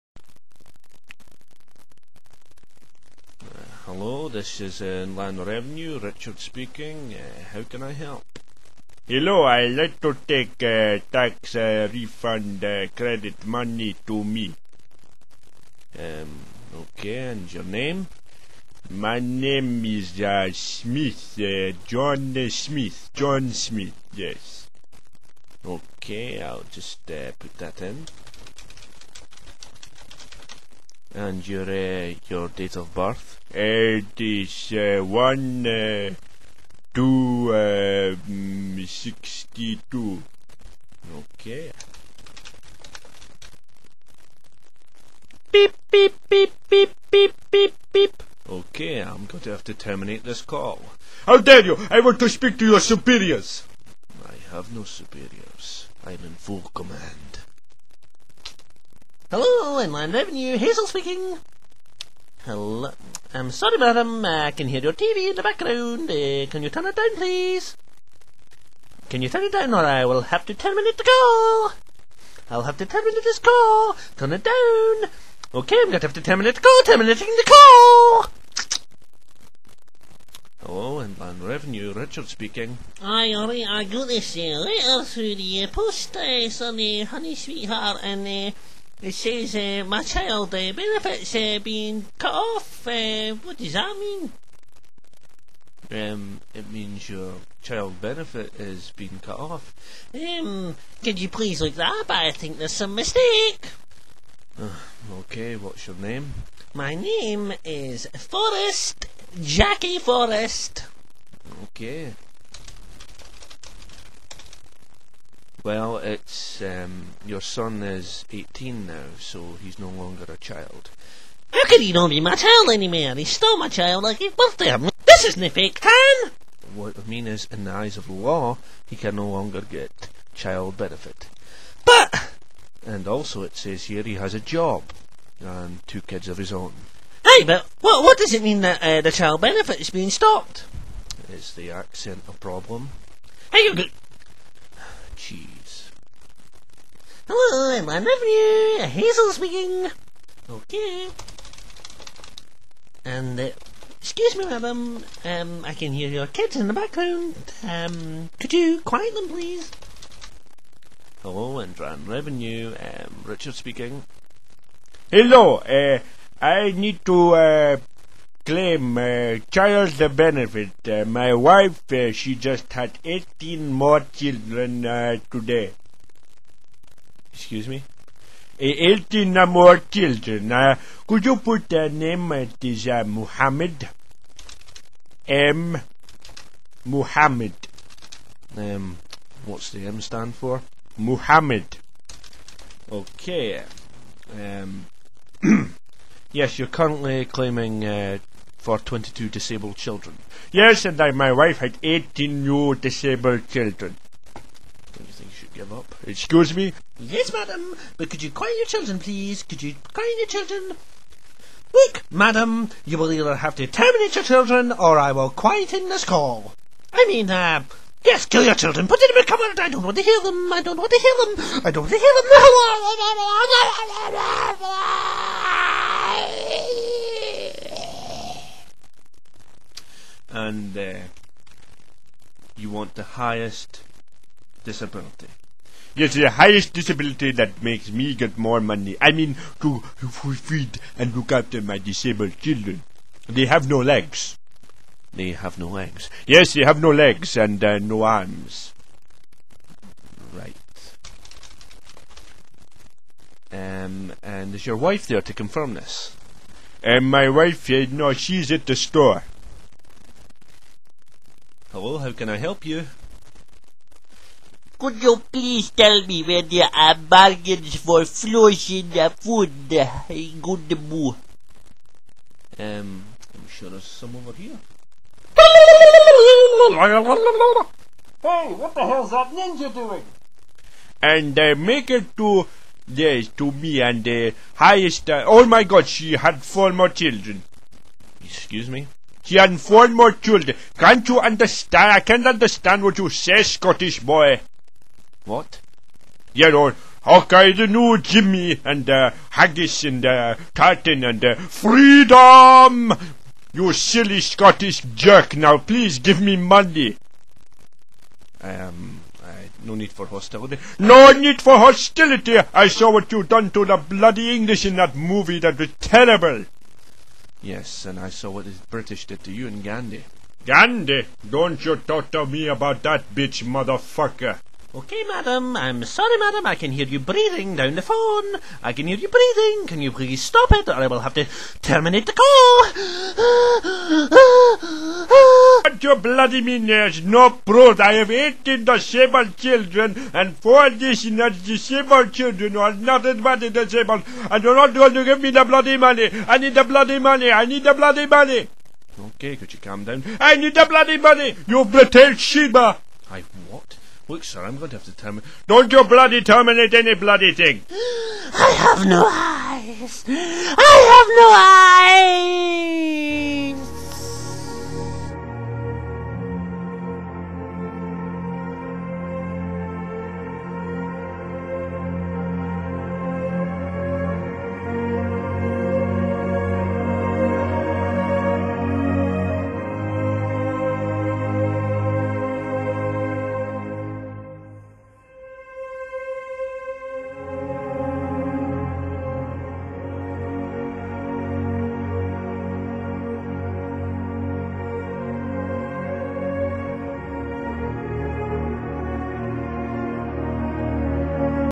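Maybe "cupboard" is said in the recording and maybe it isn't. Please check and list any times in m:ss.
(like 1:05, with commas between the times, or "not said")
3:39.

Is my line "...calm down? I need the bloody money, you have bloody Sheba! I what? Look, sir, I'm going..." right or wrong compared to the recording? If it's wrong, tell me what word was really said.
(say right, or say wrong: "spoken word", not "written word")
right.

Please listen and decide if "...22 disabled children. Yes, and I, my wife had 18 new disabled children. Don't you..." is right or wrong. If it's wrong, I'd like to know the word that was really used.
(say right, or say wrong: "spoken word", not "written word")
right.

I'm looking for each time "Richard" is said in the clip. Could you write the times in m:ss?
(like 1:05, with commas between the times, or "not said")
0:05, 1:21, 2:43.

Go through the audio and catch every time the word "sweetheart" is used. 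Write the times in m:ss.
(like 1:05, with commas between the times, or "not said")
1:27.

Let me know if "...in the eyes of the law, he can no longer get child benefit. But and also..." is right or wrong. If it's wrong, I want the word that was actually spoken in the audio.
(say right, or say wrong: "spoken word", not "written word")
right.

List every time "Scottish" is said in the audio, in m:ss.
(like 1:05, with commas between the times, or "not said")
4:53, 5:04.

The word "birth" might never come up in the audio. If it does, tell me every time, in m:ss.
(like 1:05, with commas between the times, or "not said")
0:32, 2:04.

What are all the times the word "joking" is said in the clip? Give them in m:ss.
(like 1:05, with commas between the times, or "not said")
not said.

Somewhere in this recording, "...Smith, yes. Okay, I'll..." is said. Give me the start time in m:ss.
0:23.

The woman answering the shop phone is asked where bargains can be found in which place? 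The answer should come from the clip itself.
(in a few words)
Gundaboo.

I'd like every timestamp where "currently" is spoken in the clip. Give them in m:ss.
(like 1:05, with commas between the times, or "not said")
3:16.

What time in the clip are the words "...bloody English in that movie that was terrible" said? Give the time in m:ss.
5:13.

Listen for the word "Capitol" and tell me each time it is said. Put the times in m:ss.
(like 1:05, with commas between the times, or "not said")
not said.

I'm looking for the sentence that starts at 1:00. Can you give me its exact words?
Hazel speaking hello I'm sorry, madam, I can hear your TV in the background.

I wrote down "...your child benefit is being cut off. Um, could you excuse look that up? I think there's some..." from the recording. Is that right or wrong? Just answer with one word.
wrong.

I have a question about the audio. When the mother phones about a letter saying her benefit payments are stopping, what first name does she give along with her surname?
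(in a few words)
Jackie.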